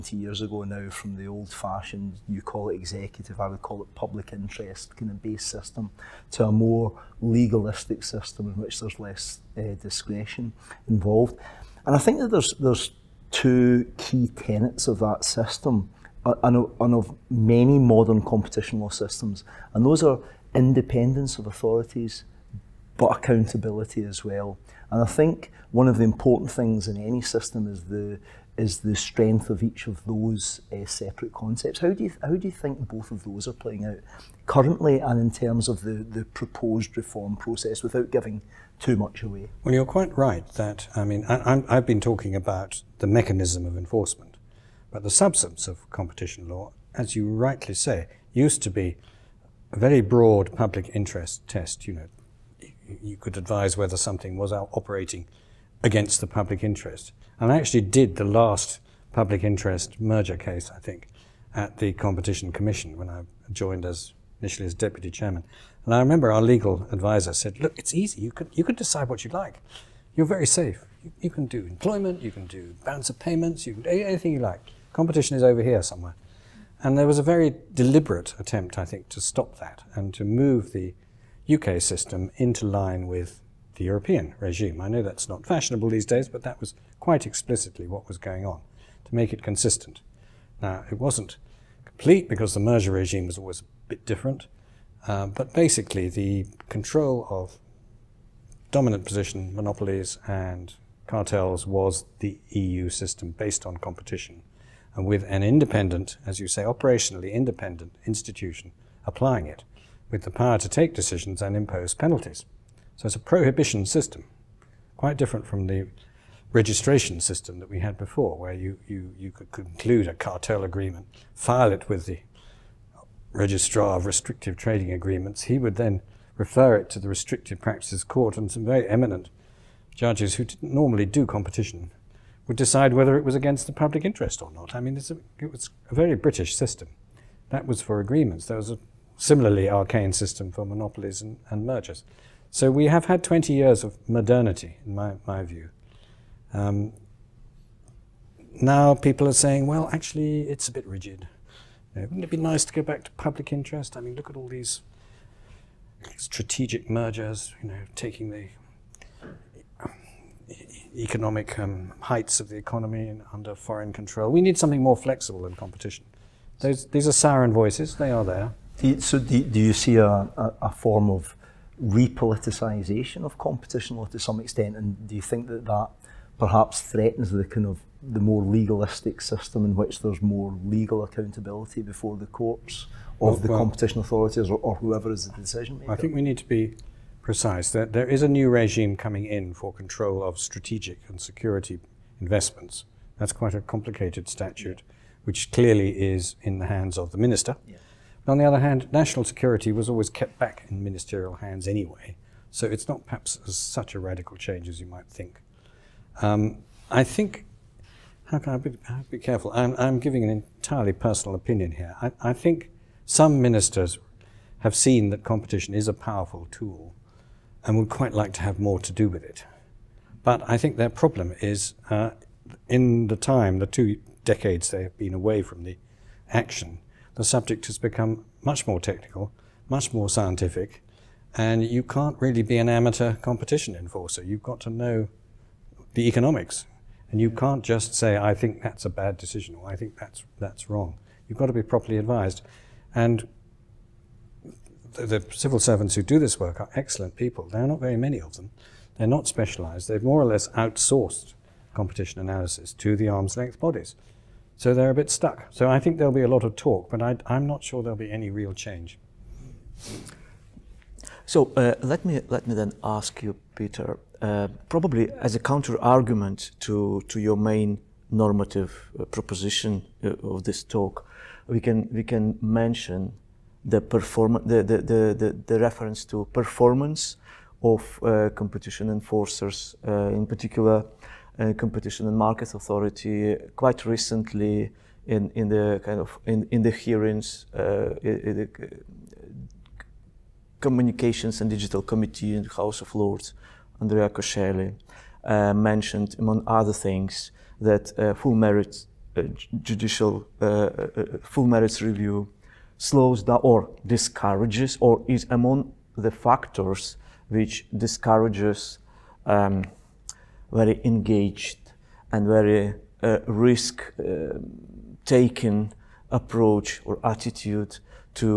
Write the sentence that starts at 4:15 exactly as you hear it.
So I think there'll be a lot of talk, but I, am not sure there'll be any real change.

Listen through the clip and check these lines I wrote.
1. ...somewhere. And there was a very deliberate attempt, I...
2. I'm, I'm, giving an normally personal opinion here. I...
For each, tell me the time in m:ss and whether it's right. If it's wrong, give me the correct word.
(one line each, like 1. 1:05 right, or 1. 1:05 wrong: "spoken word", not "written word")
1. 1:15 right
2. 3:29 wrong: "entirely", not "normally".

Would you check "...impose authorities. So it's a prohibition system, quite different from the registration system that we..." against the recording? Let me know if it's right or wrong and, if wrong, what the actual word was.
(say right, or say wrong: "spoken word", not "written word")
wrong: "penalties", not "authorities".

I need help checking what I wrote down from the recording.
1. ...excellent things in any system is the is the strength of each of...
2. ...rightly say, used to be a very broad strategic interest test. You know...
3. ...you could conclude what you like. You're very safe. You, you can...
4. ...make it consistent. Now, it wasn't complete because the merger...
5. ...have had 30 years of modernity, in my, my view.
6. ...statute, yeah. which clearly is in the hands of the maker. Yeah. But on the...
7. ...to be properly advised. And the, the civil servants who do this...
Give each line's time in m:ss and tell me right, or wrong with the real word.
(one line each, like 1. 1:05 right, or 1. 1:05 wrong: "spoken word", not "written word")
1. 0:26 wrong: "important", not "excellent"
2. 0:47 wrong: "public", not "strategic"
3. 1:08 wrong: "decide", not "conclude"
4. 1:29 right
5. 2:22 wrong: "20", not "30"
6. 3:14 wrong: "minister", not "maker"
7. 4:01 right.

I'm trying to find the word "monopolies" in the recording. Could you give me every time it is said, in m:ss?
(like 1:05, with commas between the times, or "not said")
1:39, 2:20.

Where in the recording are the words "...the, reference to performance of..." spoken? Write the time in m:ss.
4:35.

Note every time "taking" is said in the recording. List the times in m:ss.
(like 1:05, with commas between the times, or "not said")
2:37, 5:15.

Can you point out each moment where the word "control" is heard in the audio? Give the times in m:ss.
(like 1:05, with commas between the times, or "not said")
1:36, 2:43, 3:09.